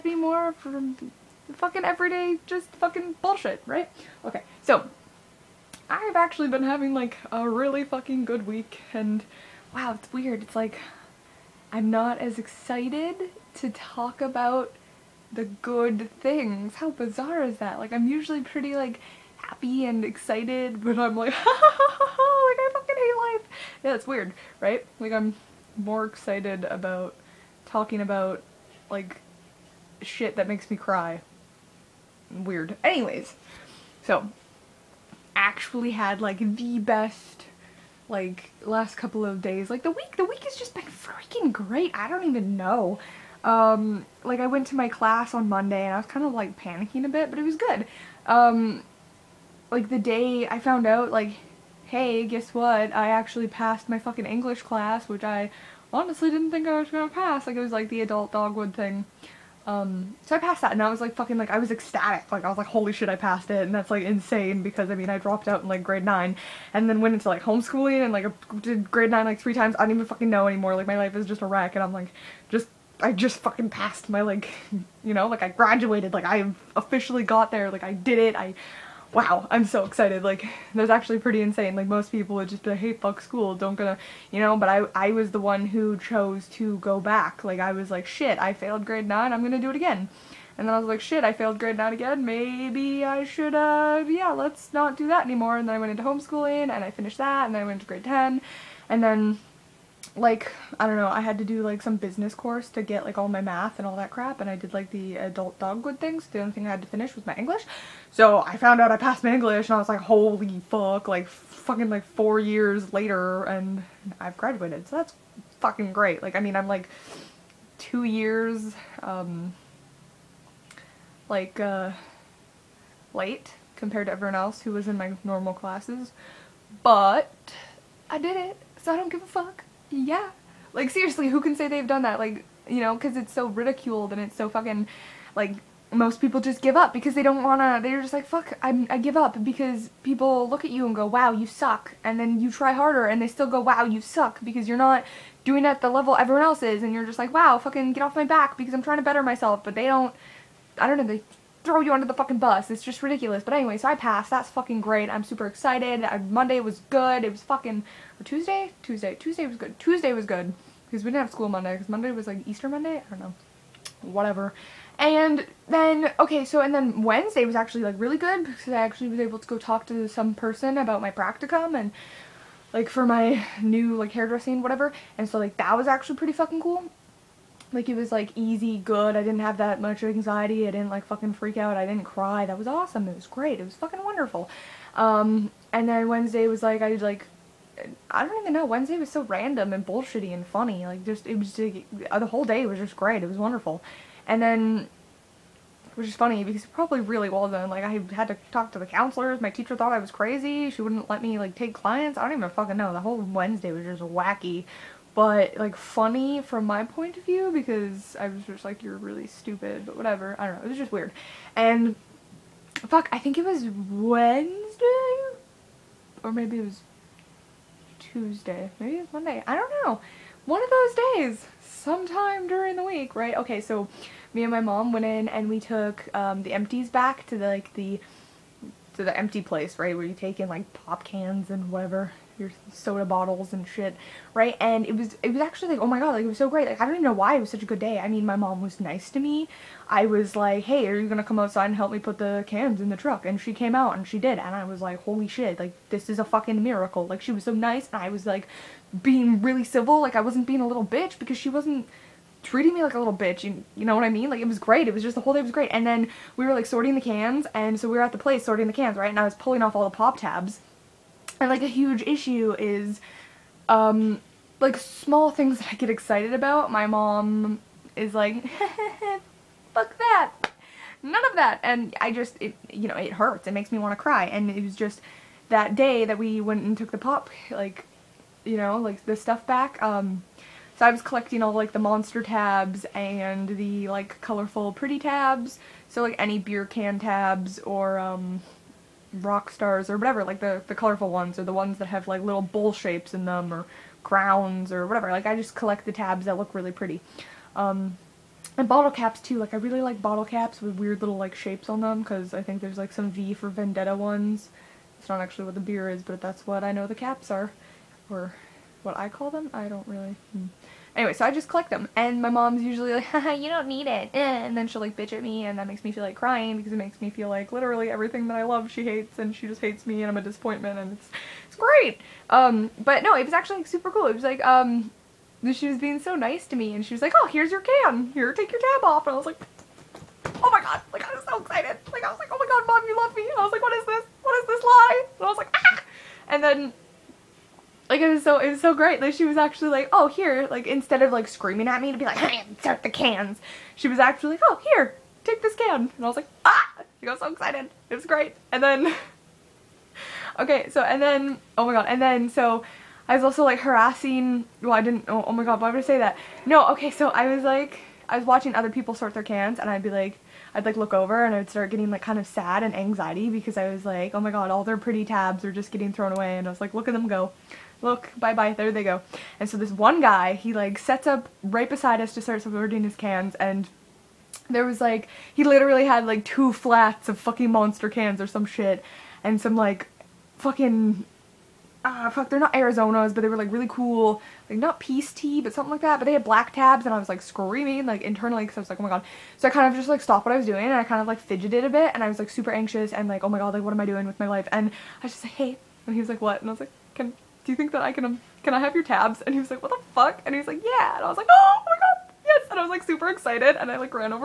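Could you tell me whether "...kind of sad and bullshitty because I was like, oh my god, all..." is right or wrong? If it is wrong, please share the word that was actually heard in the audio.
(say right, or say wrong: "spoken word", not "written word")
wrong: "anxiety", not "bullshitty".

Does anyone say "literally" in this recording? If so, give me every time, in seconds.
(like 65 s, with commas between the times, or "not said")
317 s, 375 s.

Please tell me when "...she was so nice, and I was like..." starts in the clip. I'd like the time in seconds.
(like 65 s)
247 s.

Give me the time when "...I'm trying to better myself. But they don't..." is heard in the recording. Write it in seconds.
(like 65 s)
148 s.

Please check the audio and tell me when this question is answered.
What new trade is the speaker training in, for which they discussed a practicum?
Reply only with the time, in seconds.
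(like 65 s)
174 s.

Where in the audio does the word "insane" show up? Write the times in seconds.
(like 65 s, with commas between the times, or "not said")
64 s, 81 s.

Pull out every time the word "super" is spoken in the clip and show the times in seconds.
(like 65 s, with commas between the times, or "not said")
155 s, 323 s, 392 s, 402 s.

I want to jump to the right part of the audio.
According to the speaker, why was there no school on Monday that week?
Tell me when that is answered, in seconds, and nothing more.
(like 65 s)
162 s.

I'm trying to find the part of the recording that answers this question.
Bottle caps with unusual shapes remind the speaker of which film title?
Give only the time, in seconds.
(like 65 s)
303 s.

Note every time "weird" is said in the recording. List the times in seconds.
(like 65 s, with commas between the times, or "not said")
10 s, 24 s, 32 s, 210 s, 300 s.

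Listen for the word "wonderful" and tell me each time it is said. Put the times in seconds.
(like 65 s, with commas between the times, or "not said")
184 s, 193 s.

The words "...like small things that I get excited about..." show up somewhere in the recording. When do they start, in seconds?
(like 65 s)
264 s.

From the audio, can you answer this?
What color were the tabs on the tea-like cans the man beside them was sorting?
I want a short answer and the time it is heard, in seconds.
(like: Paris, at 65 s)
Black, at 386 s.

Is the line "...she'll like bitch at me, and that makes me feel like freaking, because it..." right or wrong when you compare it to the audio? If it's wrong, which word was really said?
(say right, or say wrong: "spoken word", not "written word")
wrong: "crying", not "freaking".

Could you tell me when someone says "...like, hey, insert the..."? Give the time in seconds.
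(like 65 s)
342 s.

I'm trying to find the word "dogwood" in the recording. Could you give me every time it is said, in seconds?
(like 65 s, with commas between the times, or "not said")
58 s, 105 s.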